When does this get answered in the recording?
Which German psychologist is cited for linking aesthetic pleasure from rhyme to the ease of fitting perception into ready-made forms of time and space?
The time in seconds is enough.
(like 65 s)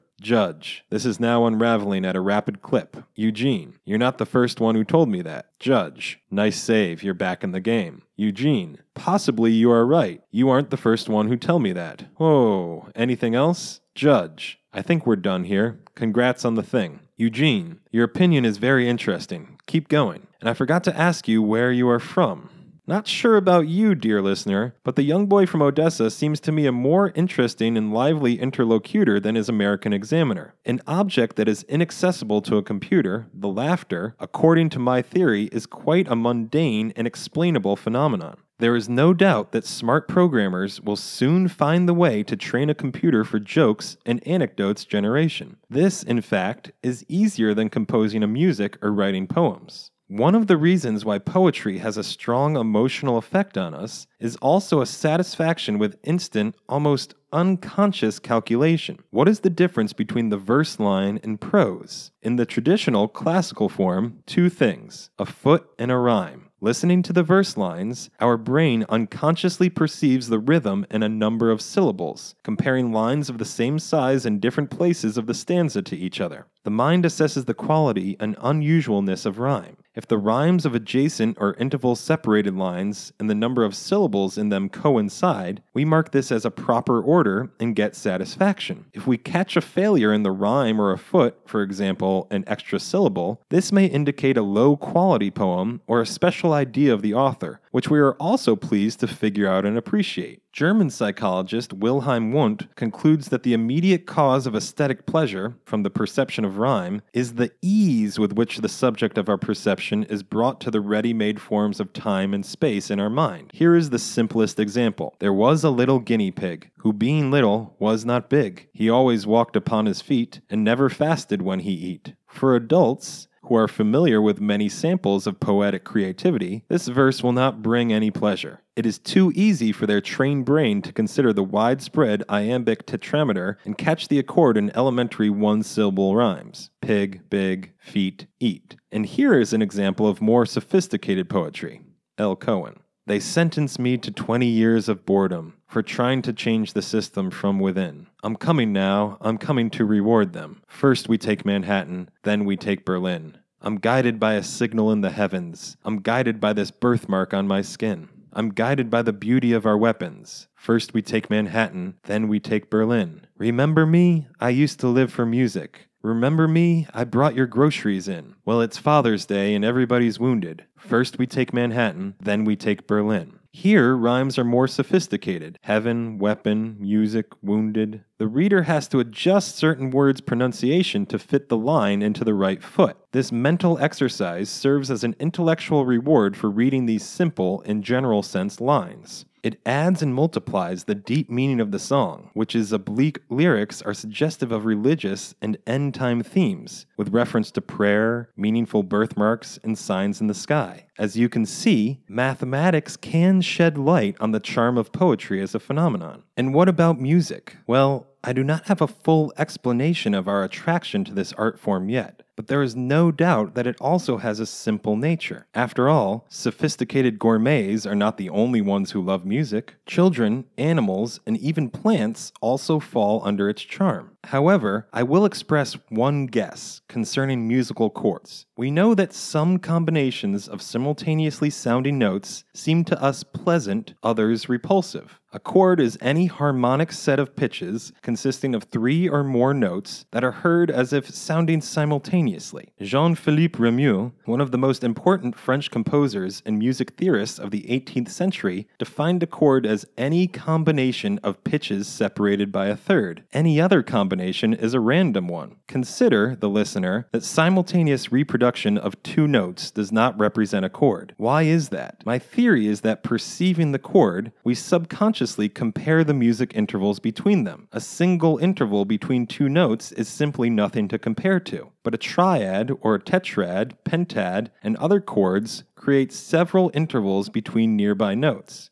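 101 s.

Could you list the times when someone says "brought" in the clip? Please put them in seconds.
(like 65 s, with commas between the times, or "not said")
110 s, 167 s.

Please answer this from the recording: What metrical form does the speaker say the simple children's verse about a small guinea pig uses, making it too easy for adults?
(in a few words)
Iambic tetrameter.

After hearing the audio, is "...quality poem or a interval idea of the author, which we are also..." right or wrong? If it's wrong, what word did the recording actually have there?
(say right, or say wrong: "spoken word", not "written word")
wrong: "special", not "interval".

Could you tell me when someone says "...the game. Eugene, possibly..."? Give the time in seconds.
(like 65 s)
7 s.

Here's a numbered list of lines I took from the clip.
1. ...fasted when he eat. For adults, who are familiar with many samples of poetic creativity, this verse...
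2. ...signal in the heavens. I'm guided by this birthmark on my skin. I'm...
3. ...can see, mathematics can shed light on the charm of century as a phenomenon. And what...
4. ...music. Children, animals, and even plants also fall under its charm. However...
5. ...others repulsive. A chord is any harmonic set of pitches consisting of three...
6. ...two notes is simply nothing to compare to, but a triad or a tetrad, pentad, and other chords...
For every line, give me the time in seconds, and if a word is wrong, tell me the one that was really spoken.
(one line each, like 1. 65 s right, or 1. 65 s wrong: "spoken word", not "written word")
1. 120 s right
2. 154 s right
3. 201 s wrong: "poetry", not "century"
4. 219 s right
5. 234 s right
6. 269 s right.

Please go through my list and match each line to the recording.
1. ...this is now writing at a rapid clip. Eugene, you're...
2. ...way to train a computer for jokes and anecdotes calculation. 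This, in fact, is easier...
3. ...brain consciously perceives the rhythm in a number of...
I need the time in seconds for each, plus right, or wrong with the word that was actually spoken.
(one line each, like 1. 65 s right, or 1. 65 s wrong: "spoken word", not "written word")
1. 0 s wrong: "unraveling", not "writing"
2. 41 s wrong: "generation", not "calculation"
3. 68 s wrong: "unconsciously", not "consciously".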